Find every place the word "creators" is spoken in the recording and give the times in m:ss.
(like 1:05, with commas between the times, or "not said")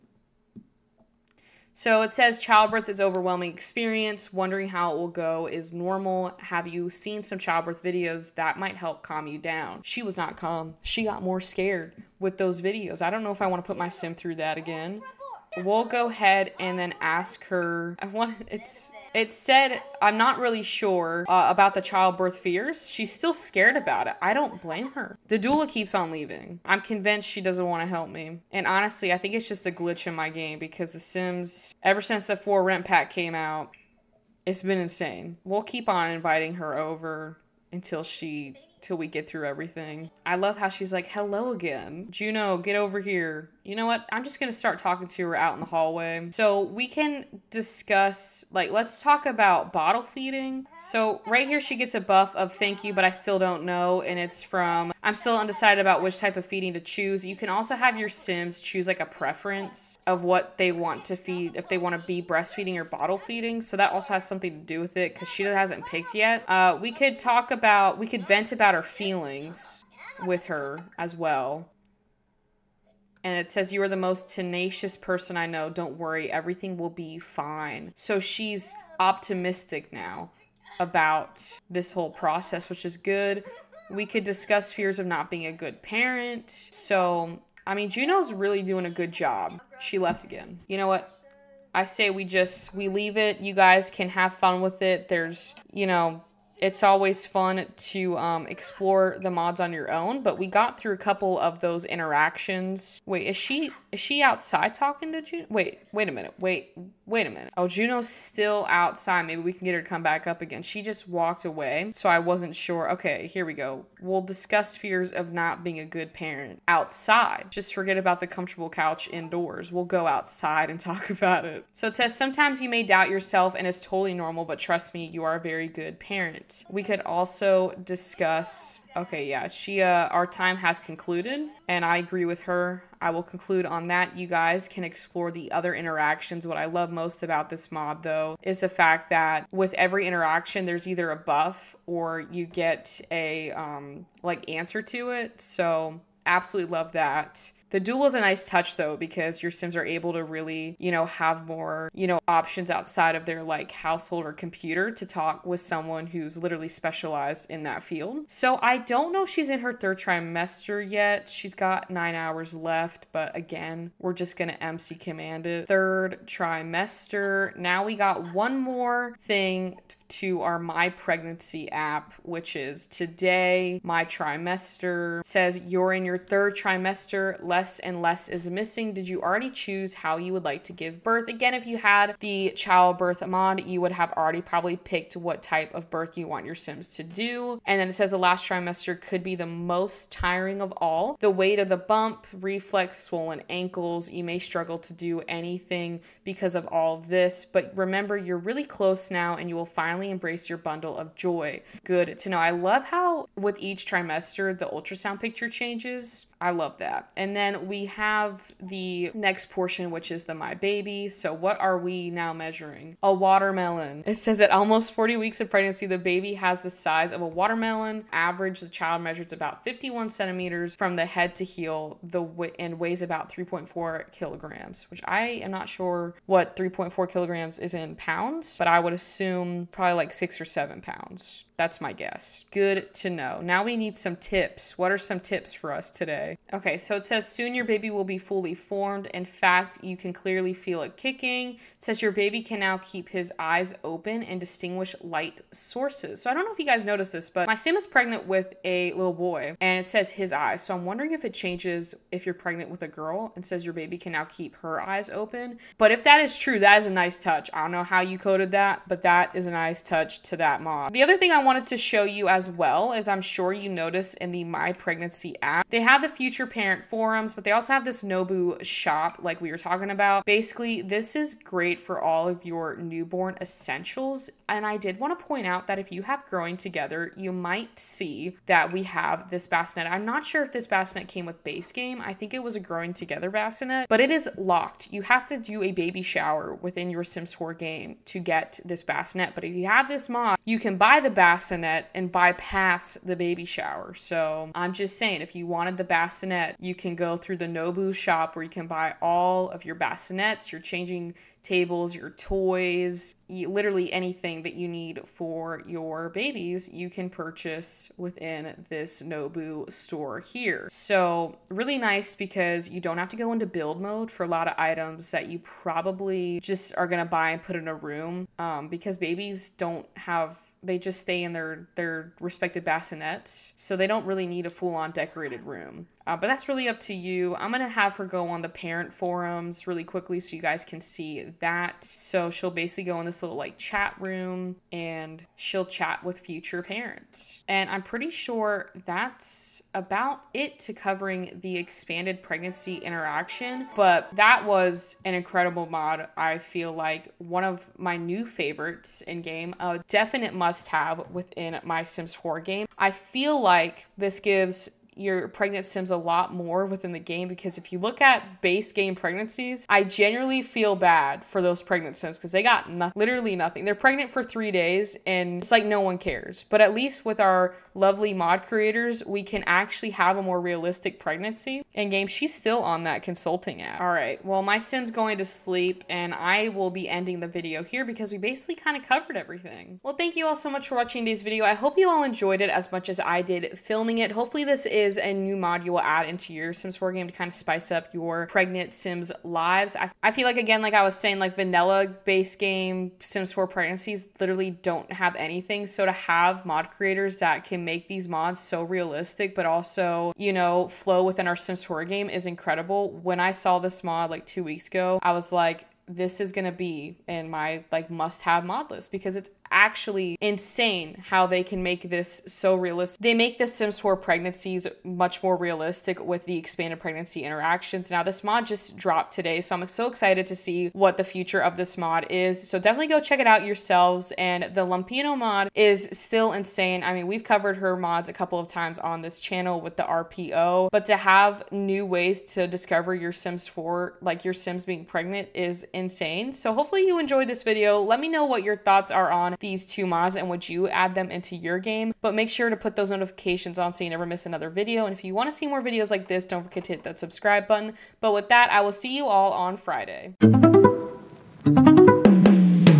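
6:08, 6:36.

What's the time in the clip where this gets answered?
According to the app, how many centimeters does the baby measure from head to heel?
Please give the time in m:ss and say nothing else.
3:39.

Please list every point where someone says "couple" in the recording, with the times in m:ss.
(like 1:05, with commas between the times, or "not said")
1:40, 7:08.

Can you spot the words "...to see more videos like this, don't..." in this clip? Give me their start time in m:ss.
7:25.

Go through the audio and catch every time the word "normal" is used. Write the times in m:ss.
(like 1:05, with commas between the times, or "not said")
0:05, 2:04.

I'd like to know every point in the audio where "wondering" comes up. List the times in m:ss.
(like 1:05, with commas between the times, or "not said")
0:04, 4:10.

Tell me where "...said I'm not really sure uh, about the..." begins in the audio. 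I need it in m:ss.
0:19.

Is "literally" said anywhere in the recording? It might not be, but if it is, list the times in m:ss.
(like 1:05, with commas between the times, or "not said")
2:36, 5:03, 6:02, 6:34.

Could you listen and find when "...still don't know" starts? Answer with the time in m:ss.
0:53.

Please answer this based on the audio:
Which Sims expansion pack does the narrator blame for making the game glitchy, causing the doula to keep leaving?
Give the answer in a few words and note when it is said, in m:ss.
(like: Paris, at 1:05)
For Rent, at 0:32.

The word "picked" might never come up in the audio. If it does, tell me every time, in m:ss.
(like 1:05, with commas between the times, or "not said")
1:05, 3:04.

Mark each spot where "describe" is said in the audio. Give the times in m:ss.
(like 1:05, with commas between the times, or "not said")
not said.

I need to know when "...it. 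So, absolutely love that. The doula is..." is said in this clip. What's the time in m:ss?
2:25.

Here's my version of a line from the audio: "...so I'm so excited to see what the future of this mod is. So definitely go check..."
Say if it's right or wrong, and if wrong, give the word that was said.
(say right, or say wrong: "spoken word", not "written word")
right.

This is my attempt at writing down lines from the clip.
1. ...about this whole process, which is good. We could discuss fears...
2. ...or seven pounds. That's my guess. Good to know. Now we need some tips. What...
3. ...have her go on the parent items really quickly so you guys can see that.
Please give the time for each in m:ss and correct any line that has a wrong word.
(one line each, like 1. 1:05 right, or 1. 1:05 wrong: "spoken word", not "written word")
1. 1:20 right
2. 3:50 right
3. 5:27 wrong: "forums", not "items".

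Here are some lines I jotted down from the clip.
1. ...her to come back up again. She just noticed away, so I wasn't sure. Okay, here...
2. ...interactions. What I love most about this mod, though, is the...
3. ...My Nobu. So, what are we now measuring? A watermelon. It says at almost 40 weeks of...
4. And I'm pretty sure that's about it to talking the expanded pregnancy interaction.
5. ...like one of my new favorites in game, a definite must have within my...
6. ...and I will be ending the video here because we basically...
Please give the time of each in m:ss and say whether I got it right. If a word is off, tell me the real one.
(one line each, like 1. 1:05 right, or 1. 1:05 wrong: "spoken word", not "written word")
1. 1:49 wrong: "walked", not "noticed"
2. 2:15 right
3. 3:30 wrong: "Baby", not "Nobu"
4. 5:37 wrong: "covering", not "talking"
5. 5:46 right
6. 6:15 right.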